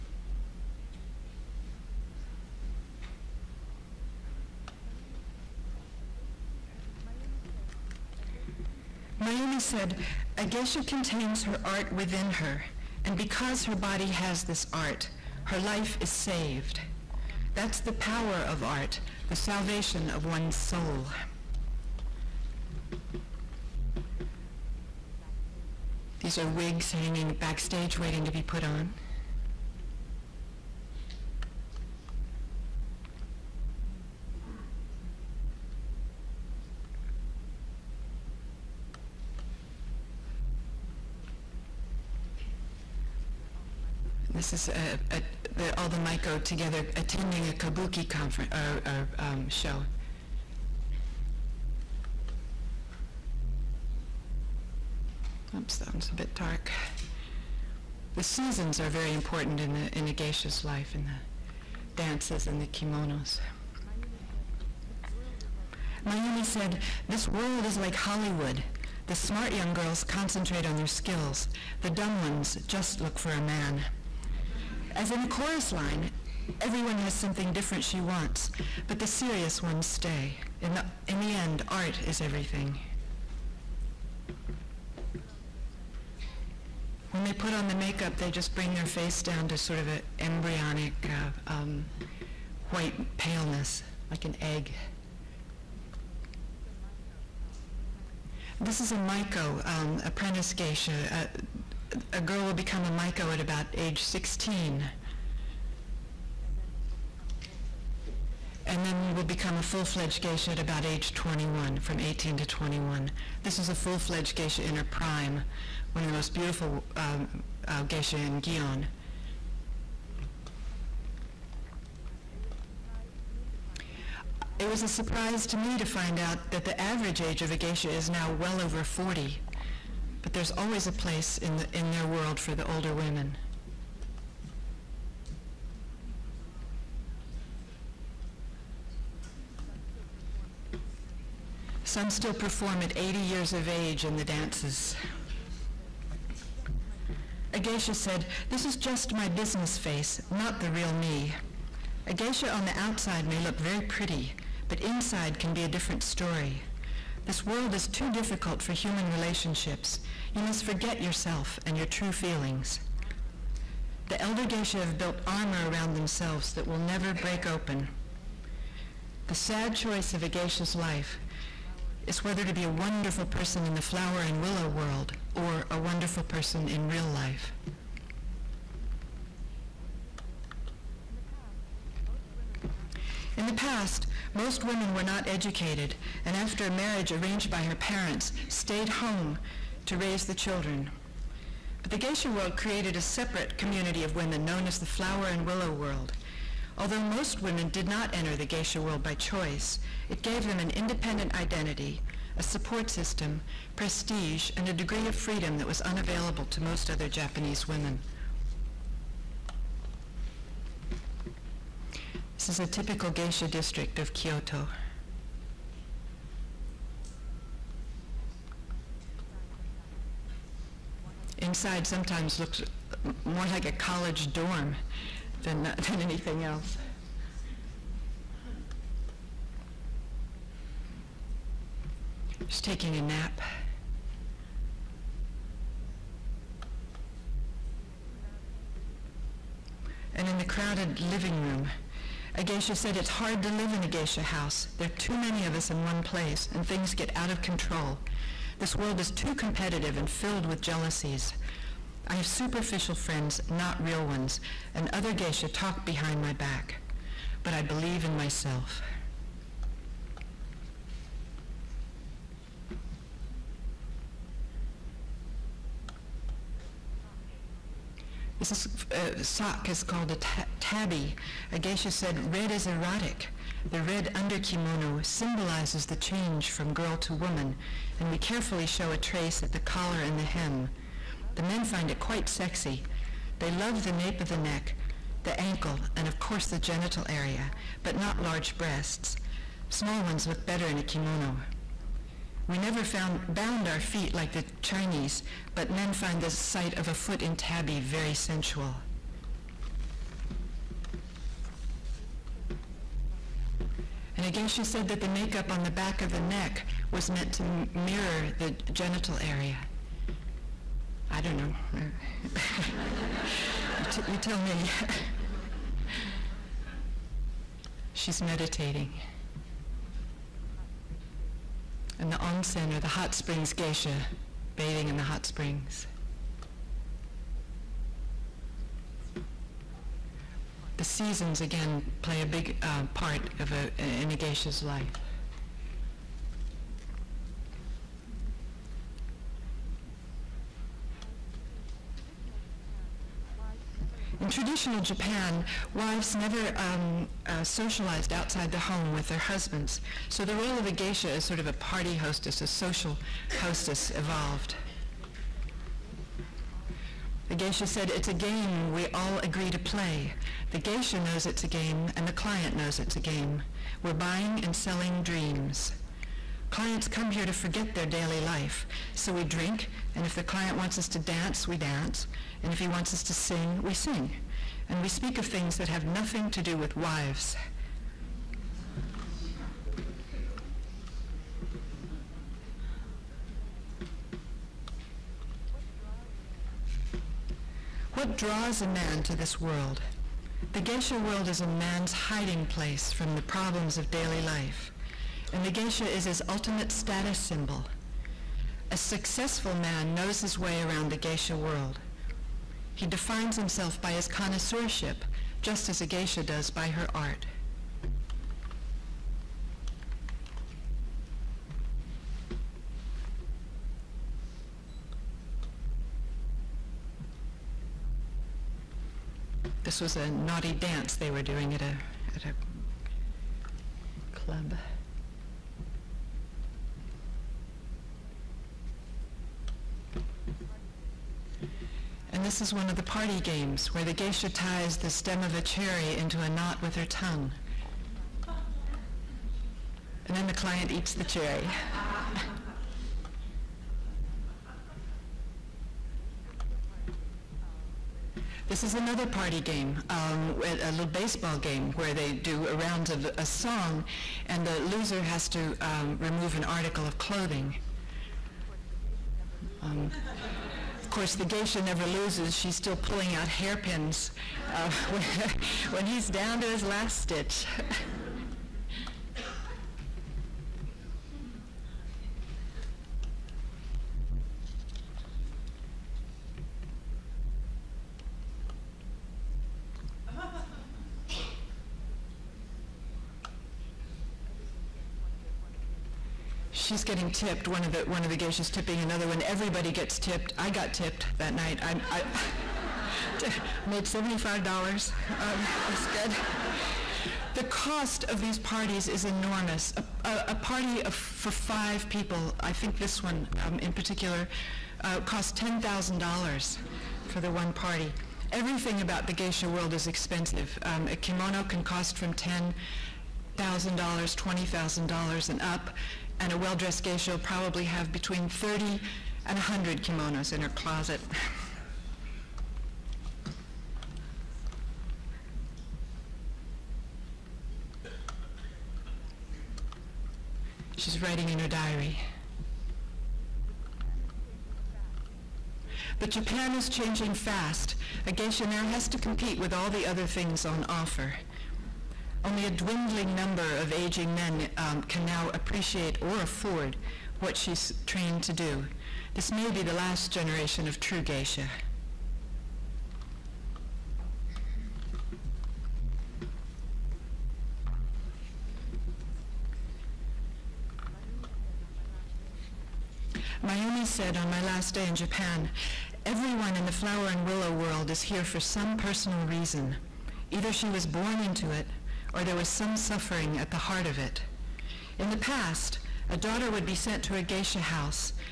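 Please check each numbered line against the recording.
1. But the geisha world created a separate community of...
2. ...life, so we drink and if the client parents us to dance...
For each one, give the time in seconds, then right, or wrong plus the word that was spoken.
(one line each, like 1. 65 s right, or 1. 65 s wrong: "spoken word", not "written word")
1. 191 s right
2. 368 s wrong: "wants", not "parents".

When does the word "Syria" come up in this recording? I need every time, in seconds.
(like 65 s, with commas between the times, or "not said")
not said.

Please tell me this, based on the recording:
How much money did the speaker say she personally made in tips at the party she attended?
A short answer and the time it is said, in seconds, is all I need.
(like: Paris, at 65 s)
$75, at 493 s.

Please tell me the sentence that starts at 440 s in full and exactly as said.
And then the client eats the cherry.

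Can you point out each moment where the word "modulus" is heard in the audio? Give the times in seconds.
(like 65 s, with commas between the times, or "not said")
not said.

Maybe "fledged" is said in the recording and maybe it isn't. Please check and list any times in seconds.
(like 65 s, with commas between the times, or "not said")
109 s, 113 s.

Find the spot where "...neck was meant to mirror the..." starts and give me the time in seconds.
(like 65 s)
306 s.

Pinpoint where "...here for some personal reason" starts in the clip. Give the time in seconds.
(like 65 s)
568 s.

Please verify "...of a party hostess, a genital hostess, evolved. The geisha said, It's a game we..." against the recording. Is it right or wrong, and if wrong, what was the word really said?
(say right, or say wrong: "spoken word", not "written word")
wrong: "social", not "genital".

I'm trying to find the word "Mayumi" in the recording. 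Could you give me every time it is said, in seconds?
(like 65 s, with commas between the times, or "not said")
9 s, 66 s, 563 s.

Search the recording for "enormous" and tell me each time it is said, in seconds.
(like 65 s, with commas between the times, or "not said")
499 s.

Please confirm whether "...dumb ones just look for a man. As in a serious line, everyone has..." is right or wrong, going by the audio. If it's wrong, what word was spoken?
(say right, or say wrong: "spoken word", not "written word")
wrong: "chorus", not "serious".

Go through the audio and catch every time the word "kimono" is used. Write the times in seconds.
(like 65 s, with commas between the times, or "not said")
62 s, 274 s, 290 s, 510 s, 519 s.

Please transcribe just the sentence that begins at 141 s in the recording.
Some still perform at 80 years of age in the dances.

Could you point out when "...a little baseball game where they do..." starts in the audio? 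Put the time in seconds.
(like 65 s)
450 s.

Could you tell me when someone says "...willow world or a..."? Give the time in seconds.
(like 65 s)
174 s.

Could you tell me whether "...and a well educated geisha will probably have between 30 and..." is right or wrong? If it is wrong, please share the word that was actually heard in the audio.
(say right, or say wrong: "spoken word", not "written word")
wrong: "dressed", not "educated".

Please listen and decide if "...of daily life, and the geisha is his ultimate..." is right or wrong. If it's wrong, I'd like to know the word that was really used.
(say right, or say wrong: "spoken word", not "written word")
right.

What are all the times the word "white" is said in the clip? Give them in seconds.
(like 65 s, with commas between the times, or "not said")
92 s.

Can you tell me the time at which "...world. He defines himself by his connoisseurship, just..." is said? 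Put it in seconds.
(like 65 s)
401 s.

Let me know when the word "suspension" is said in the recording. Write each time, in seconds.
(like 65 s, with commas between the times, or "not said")
not said.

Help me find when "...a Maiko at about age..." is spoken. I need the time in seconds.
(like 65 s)
102 s.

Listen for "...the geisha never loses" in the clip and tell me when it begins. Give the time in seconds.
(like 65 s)
461 s.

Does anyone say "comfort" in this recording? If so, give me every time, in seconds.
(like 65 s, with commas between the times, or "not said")
not said.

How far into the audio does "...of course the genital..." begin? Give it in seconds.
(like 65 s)
286 s.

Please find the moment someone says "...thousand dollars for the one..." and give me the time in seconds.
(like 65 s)
505 s.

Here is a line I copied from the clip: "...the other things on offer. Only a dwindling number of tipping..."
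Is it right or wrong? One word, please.
wrong.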